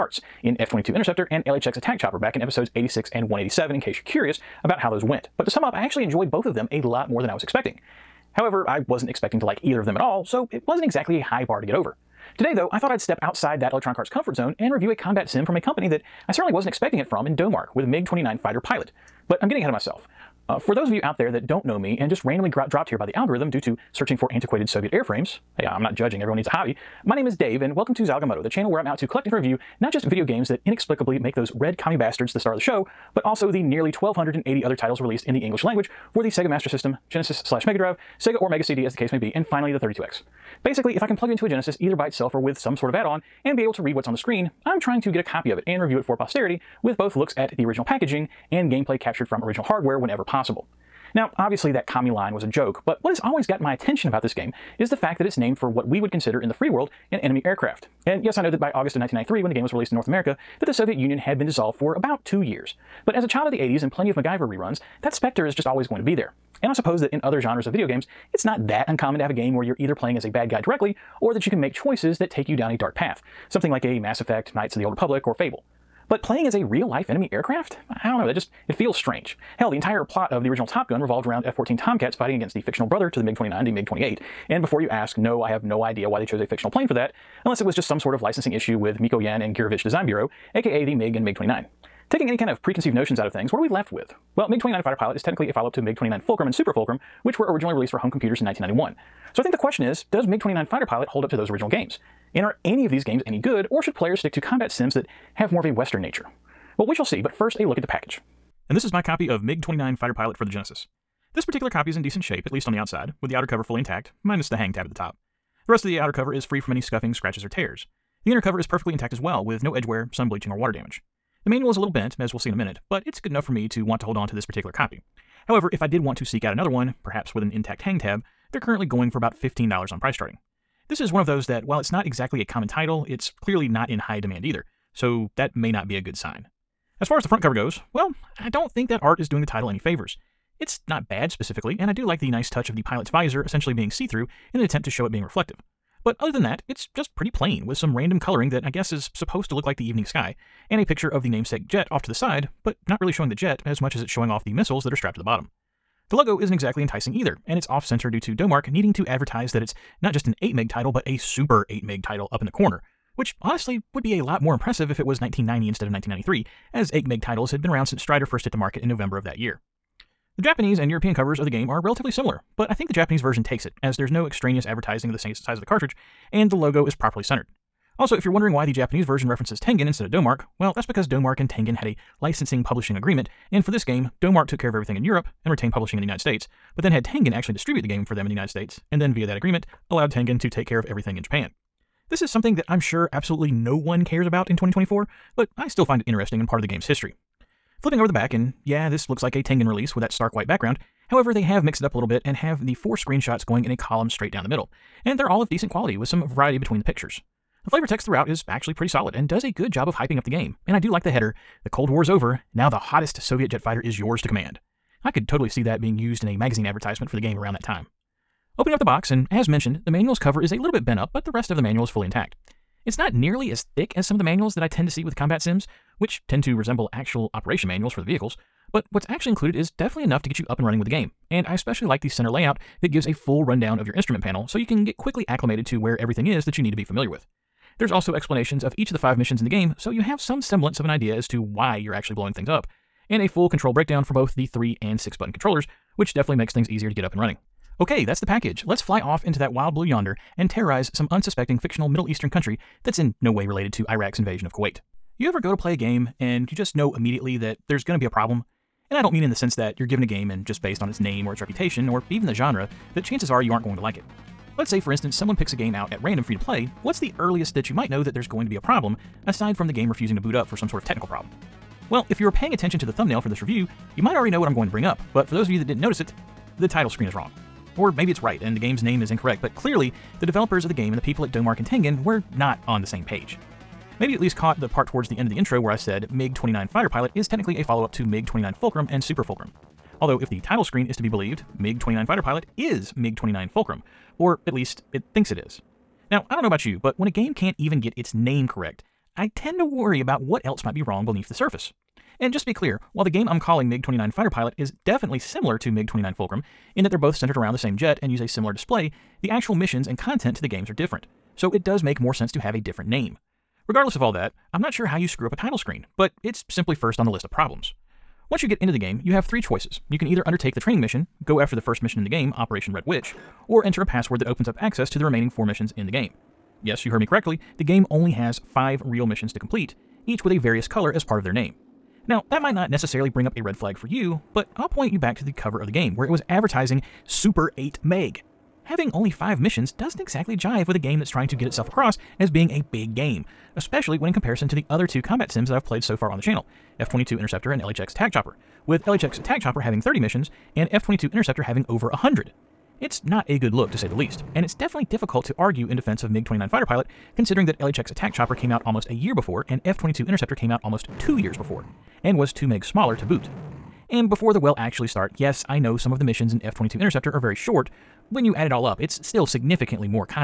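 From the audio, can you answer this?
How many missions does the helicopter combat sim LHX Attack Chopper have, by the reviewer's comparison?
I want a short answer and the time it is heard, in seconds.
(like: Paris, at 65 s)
30, at 349 s.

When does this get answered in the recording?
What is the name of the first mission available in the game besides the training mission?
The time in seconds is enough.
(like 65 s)
322 s.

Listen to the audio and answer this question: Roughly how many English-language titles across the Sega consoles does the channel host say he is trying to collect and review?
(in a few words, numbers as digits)
1,280.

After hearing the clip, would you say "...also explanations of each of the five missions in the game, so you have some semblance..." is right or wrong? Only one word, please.
right.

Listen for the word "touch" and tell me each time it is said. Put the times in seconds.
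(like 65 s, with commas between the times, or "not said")
142 s.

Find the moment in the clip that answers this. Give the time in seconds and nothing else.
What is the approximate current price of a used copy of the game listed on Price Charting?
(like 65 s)
129 s.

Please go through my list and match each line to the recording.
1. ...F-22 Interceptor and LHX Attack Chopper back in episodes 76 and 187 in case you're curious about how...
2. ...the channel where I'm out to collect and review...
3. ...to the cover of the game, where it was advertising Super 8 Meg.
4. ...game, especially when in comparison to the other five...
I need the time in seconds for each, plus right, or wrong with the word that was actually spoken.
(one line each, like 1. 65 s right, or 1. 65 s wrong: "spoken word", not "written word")
1. 0 s wrong: "86", not "76"
2. 28 s right
3. 335 s right
4. 342 s wrong: "two", not "five".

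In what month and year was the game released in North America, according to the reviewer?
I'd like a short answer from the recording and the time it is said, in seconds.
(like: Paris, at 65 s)
August 1993, at 58 s.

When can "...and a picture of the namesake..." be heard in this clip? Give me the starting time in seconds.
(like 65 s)
150 s.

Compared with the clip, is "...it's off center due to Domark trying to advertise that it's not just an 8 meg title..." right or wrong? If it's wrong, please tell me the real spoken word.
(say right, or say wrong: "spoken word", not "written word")
wrong: "needing", not "trying".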